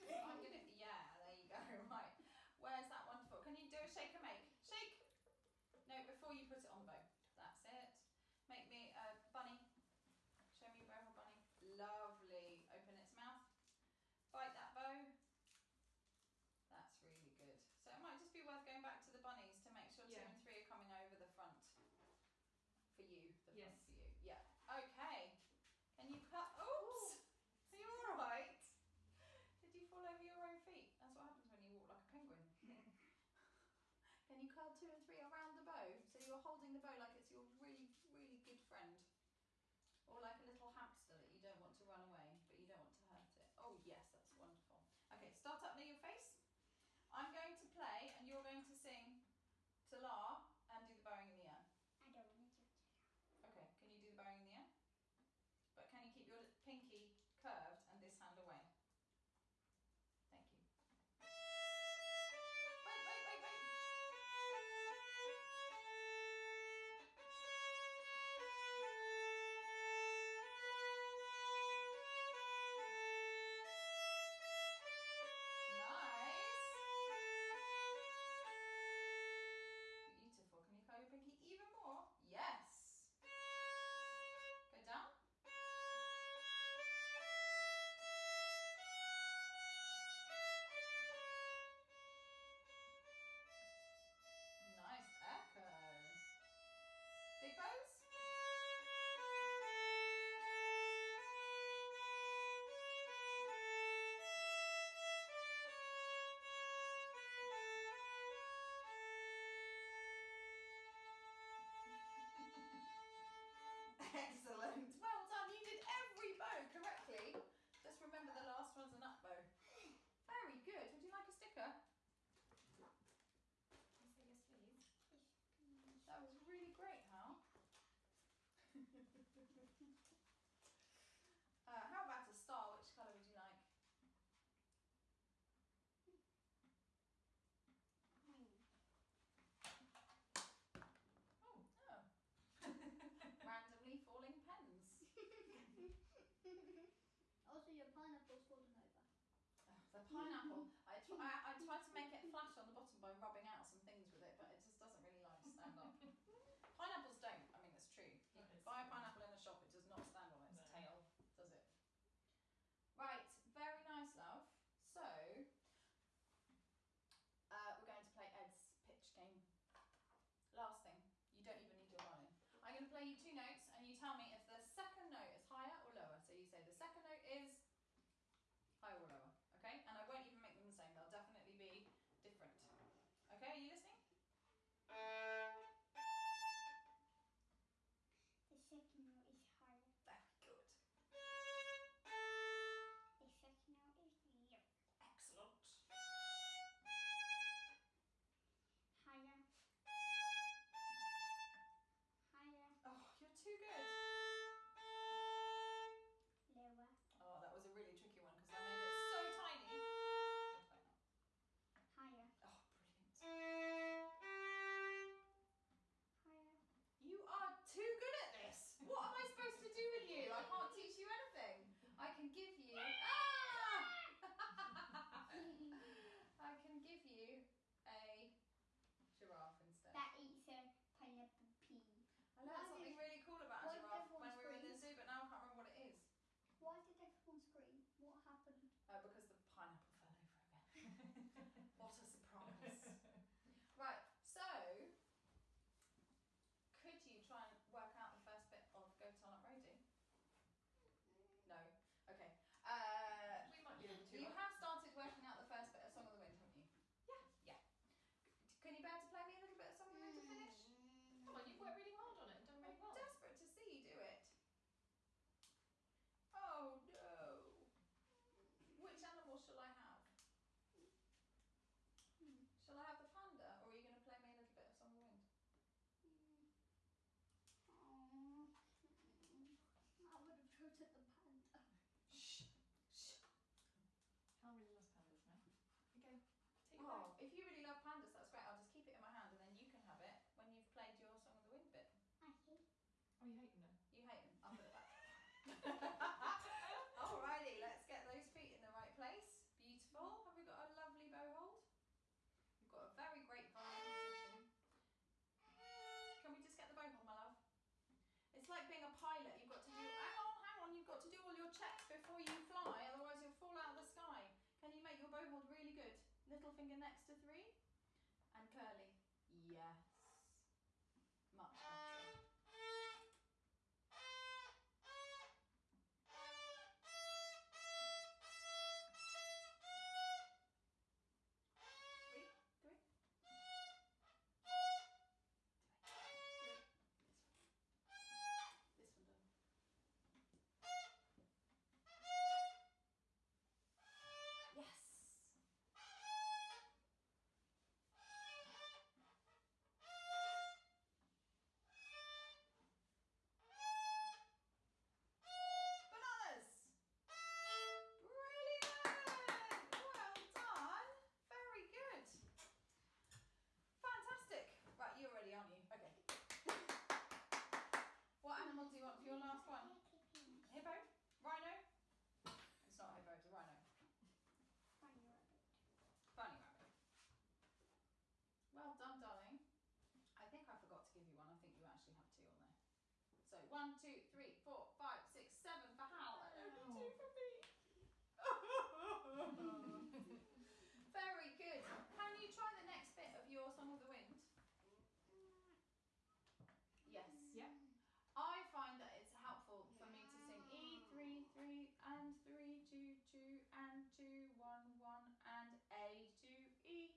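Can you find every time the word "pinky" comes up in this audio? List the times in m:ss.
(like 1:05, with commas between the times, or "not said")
0:56.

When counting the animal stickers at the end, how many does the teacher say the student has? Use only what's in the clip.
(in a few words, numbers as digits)
7.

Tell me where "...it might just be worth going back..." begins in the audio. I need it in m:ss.
0:17.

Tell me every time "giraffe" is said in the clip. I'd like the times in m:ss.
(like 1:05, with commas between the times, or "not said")
3:49, 3:53.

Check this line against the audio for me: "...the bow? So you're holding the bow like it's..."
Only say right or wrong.
right.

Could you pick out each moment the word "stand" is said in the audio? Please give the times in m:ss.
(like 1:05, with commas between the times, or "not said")
2:35, 2:40.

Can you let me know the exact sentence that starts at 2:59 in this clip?
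And I won't even make them the same, they'll definitely be different.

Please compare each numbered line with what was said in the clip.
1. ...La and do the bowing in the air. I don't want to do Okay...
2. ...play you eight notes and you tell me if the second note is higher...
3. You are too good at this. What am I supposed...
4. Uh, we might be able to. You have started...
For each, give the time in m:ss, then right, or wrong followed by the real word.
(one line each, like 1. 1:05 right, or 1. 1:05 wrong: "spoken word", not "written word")
1. 0:49 right
2. 2:52 wrong: "two", not "eight"
3. 3:36 right
4. 4:12 right.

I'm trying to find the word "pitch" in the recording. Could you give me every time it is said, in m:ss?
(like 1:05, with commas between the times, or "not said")
2:48.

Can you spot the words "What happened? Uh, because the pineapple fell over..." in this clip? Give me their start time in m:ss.
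3:57.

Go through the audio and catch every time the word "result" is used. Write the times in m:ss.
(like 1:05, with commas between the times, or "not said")
not said.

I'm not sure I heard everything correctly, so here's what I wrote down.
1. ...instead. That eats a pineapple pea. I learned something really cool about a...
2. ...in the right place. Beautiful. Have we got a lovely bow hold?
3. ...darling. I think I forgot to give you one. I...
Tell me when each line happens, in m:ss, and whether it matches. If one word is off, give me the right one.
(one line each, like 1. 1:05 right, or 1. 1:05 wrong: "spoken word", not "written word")
1. 3:49 right
2. 4:58 right
3. 6:18 right.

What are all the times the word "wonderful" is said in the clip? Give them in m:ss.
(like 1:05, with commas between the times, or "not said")
0:03, 0:44.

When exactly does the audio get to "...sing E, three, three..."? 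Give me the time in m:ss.
6:40.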